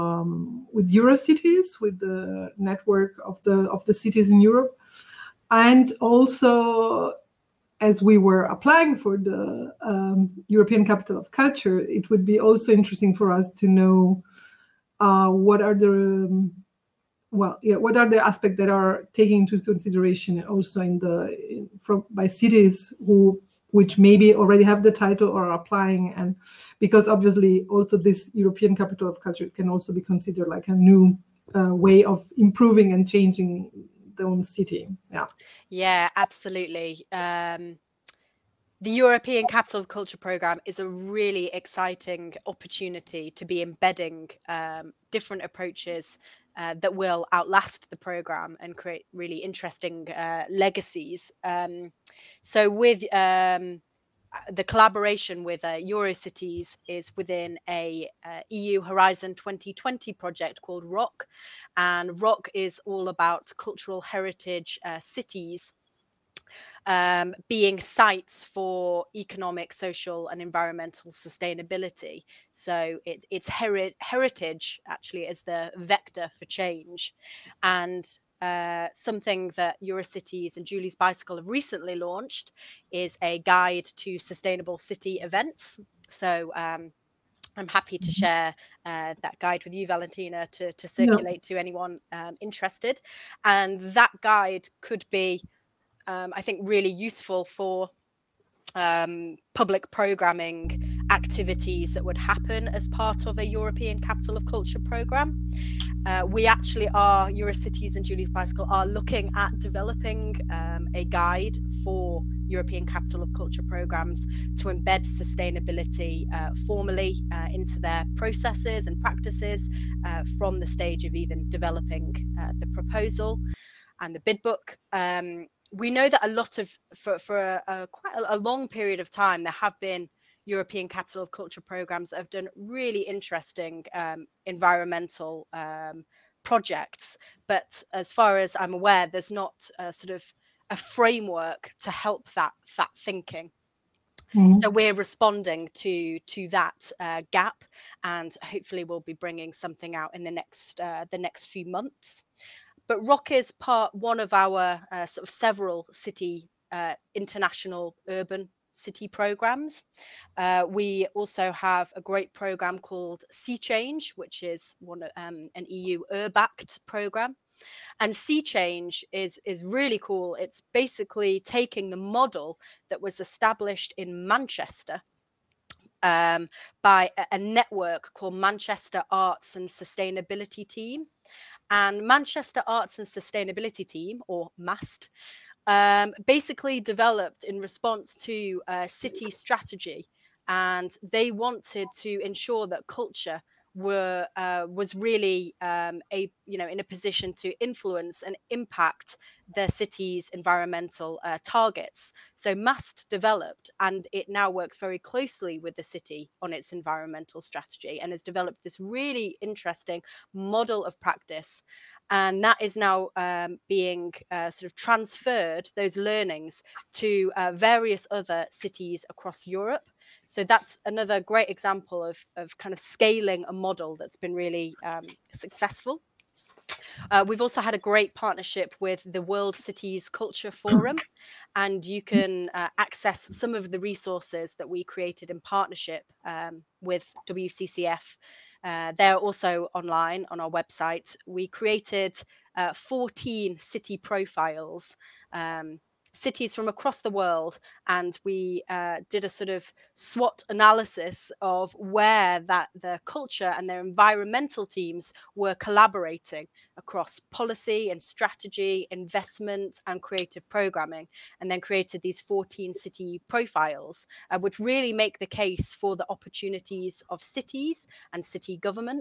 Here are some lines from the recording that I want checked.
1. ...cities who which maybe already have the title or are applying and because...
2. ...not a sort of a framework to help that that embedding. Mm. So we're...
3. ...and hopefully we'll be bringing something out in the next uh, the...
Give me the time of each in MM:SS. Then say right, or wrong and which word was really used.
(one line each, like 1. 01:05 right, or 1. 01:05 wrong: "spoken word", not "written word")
1. 00:22 right
2. 02:19 wrong: "thinking", not "embedding"
3. 02:28 right.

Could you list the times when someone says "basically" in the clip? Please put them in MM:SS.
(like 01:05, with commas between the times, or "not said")
02:50, 03:06.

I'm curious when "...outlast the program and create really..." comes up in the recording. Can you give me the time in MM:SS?
00:47.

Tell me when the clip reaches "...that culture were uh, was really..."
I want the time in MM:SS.
03:12.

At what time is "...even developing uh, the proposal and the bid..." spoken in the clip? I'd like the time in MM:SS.
02:01.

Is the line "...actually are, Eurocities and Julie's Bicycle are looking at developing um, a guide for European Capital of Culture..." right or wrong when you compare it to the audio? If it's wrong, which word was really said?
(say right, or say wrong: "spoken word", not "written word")
right.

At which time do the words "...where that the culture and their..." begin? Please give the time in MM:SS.
04:11.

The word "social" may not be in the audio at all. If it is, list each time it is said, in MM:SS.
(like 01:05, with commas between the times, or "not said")
01:09.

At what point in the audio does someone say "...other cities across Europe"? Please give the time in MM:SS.
03:38.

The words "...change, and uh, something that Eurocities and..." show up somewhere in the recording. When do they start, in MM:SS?
01:16.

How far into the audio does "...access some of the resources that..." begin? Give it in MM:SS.
03:52.